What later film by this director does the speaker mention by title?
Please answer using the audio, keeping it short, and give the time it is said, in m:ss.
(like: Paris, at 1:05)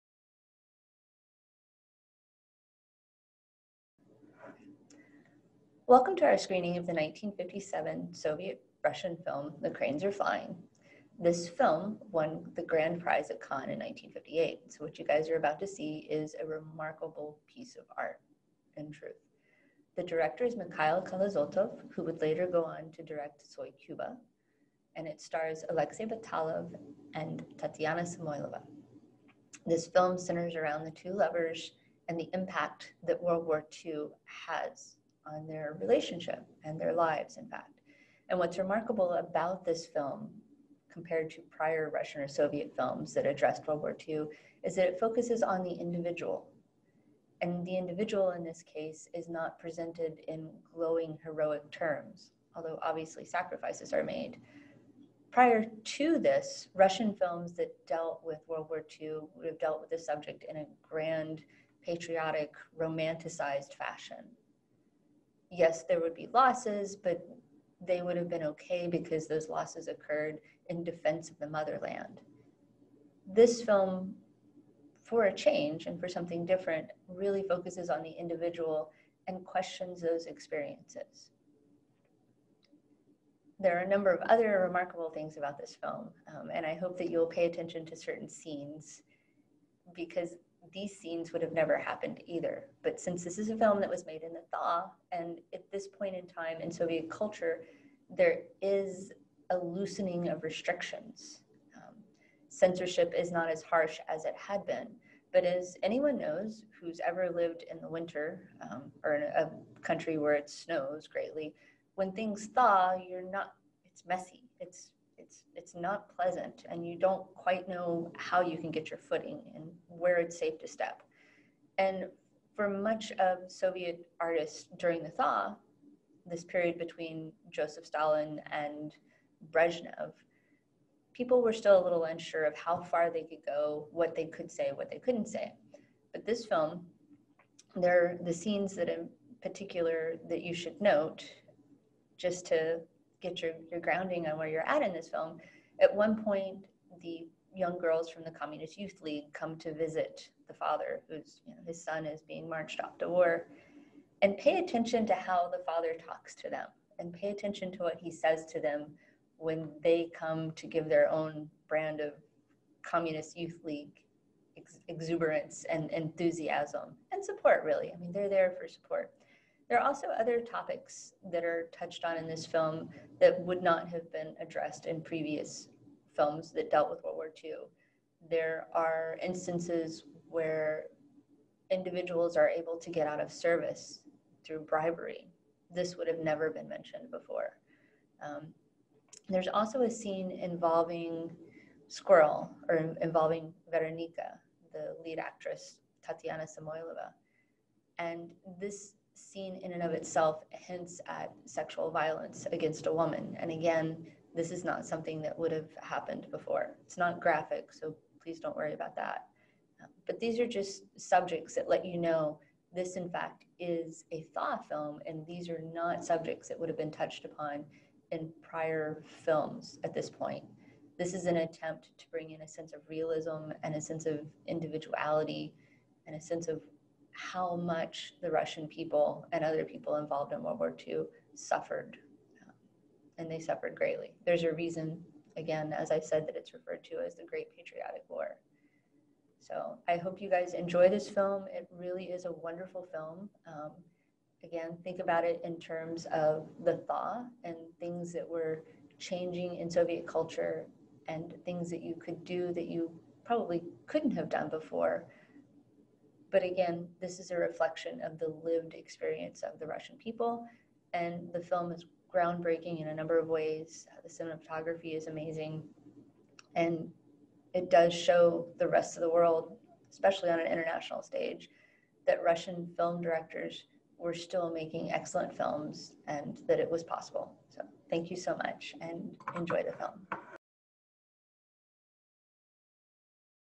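Soy Cuba, at 0:23.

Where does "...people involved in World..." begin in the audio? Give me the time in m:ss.
3:49.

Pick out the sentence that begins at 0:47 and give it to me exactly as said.
And the individual in this case is not presented in glowing heroic terms, although obviously sacrifices are made.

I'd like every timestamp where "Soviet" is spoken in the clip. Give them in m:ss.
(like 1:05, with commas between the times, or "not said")
0:08, 0:42, 1:36, 2:03, 4:09.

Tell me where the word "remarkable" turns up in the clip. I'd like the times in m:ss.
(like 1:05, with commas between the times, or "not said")
0:16, 0:38, 1:24.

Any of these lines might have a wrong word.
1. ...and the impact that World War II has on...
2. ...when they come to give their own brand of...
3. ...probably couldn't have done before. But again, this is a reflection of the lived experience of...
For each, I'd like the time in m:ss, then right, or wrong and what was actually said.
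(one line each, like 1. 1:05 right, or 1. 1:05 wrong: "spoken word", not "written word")
1. 0:32 right
2. 2:39 right
3. 4:13 right.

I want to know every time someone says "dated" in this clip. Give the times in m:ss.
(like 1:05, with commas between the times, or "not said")
not said.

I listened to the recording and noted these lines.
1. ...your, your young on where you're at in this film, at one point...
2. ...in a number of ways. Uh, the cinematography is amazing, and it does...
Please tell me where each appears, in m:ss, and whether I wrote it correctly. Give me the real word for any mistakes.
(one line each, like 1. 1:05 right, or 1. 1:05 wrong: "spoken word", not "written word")
1. 2:23 wrong: "grounding", not "young"
2. 4:22 right.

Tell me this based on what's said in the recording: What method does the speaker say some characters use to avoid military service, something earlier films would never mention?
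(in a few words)
Bribery.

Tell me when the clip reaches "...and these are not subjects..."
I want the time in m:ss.
3:35.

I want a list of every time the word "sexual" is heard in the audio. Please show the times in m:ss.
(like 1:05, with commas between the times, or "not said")
3:21.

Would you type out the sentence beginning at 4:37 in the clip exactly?
So, thank you so much and enjoy the film.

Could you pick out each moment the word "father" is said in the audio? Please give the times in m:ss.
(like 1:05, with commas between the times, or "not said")
2:30, 2:35.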